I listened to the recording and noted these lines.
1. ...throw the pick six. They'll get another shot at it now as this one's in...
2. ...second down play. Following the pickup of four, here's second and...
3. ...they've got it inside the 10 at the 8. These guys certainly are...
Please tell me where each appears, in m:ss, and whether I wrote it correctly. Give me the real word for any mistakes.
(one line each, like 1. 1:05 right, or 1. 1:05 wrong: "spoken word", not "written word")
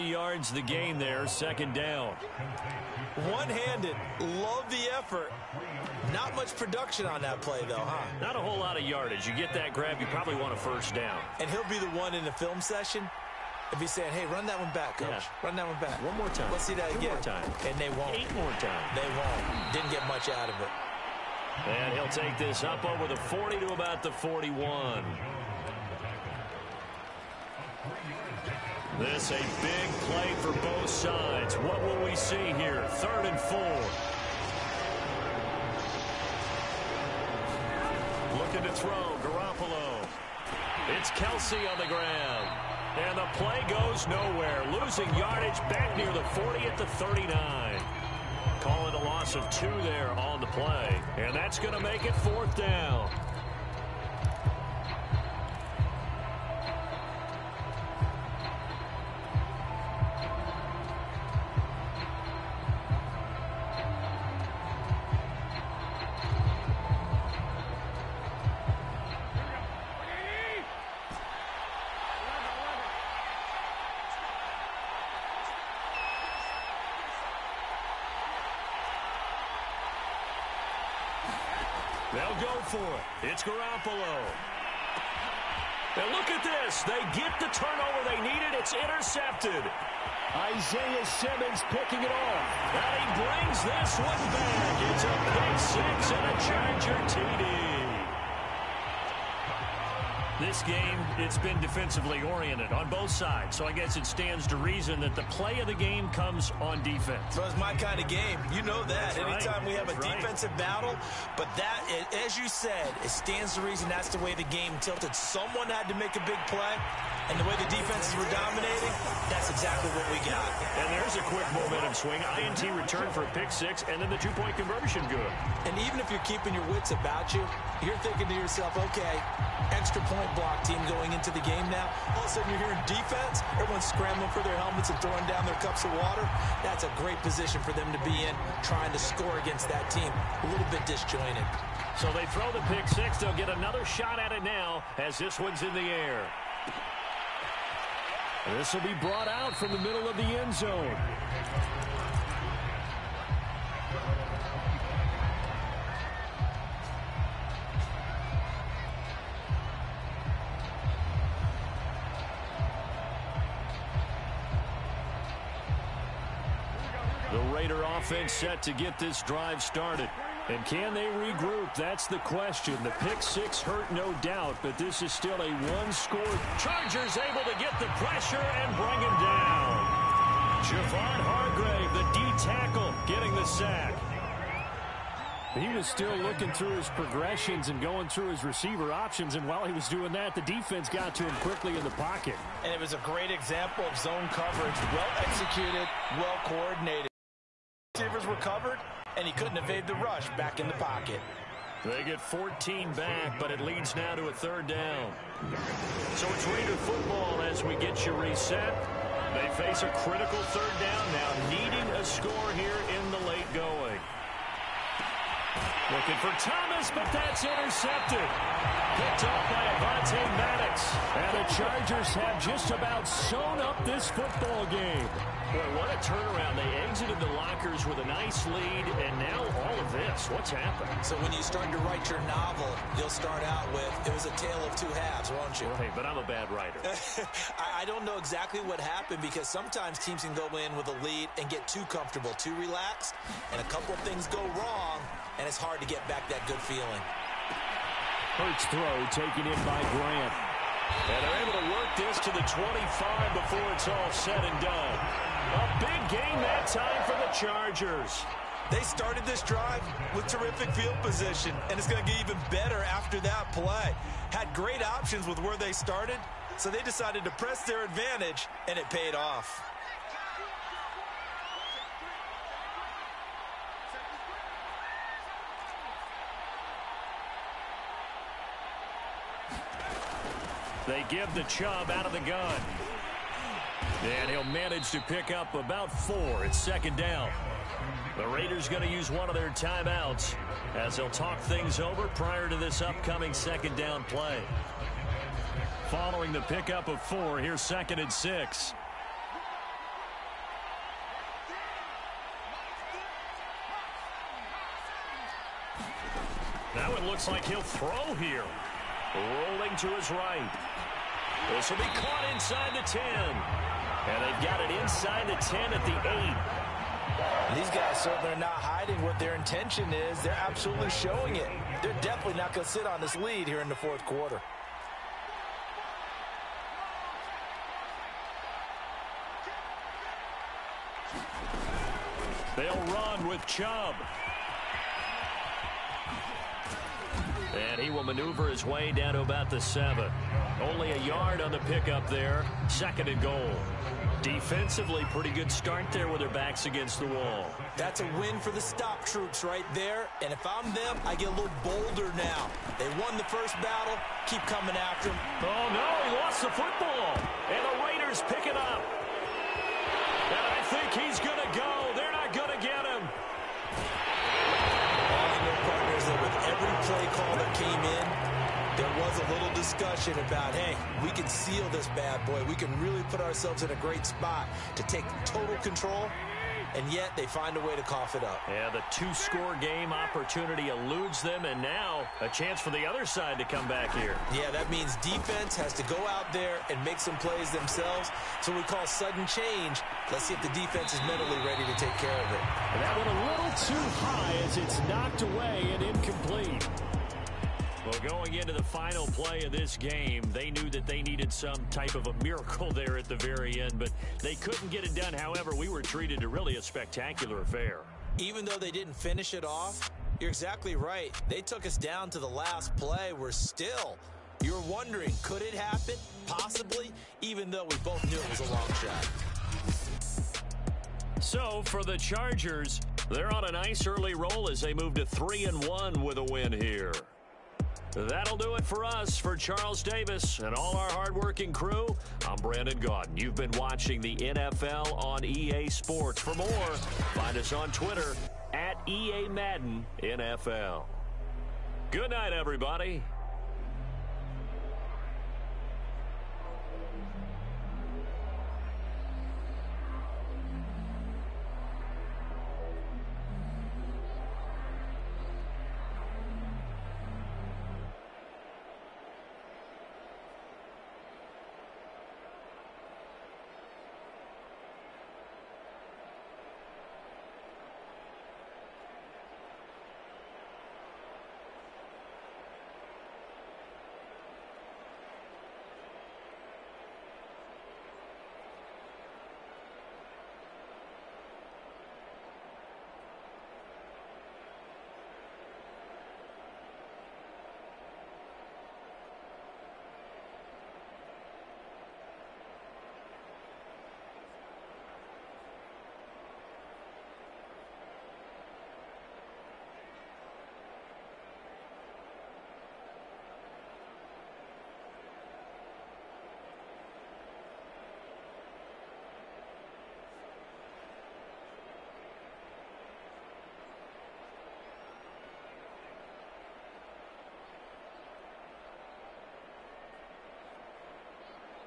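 1. 2:22 right
2. 4:53 right
3. 5:14 right.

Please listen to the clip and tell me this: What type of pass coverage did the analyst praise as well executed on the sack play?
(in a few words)
zone coverage.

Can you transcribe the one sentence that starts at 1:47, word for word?
Well, it's my kind of game.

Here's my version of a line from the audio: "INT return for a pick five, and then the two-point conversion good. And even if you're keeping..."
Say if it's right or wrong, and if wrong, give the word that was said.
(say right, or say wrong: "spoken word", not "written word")
wrong: "six", not "five".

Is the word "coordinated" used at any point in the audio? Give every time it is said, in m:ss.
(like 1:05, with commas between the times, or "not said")
3:16.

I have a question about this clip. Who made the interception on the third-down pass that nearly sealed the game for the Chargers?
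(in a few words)
Avonte Maddox.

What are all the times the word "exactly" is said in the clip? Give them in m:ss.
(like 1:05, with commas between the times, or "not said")
1:59, 3:58, 6:50.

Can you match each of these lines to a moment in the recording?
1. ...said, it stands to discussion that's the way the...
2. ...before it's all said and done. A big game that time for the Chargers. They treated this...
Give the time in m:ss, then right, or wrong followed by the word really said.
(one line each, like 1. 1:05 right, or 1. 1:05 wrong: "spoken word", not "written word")
1. 1:52 wrong: "reason", not "discussion"
2. 4:13 wrong: "started", not "treated".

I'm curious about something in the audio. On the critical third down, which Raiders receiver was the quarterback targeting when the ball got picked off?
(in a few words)
Thomas.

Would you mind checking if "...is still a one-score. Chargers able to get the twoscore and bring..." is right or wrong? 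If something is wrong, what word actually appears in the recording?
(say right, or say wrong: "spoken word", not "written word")
wrong: "pressure", not "twoscore".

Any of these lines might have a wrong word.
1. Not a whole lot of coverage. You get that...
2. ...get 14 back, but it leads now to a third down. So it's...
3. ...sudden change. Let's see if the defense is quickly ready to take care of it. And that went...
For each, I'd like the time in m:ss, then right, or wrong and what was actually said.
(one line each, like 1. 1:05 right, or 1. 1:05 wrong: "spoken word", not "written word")
1. 0:08 wrong: "yardage", not "coverage"
2. 3:22 right
3. 6:28 wrong: "mentally", not "quickly".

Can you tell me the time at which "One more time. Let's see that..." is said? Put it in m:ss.
0:16.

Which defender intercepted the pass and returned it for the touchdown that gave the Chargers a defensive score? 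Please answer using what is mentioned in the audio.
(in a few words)
Isaiah Simmons.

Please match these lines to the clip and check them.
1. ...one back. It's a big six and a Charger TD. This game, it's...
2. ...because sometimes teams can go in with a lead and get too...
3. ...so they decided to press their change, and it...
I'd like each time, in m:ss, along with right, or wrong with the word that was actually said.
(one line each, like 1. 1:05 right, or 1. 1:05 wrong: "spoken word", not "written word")
1. 1:33 right
2. 3:59 right
3. 4:26 wrong: "advantage", not "change".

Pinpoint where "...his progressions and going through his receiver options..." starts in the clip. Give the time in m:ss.
3:06.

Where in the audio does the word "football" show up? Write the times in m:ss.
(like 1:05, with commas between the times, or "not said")
3:26, 3:44, 5:56.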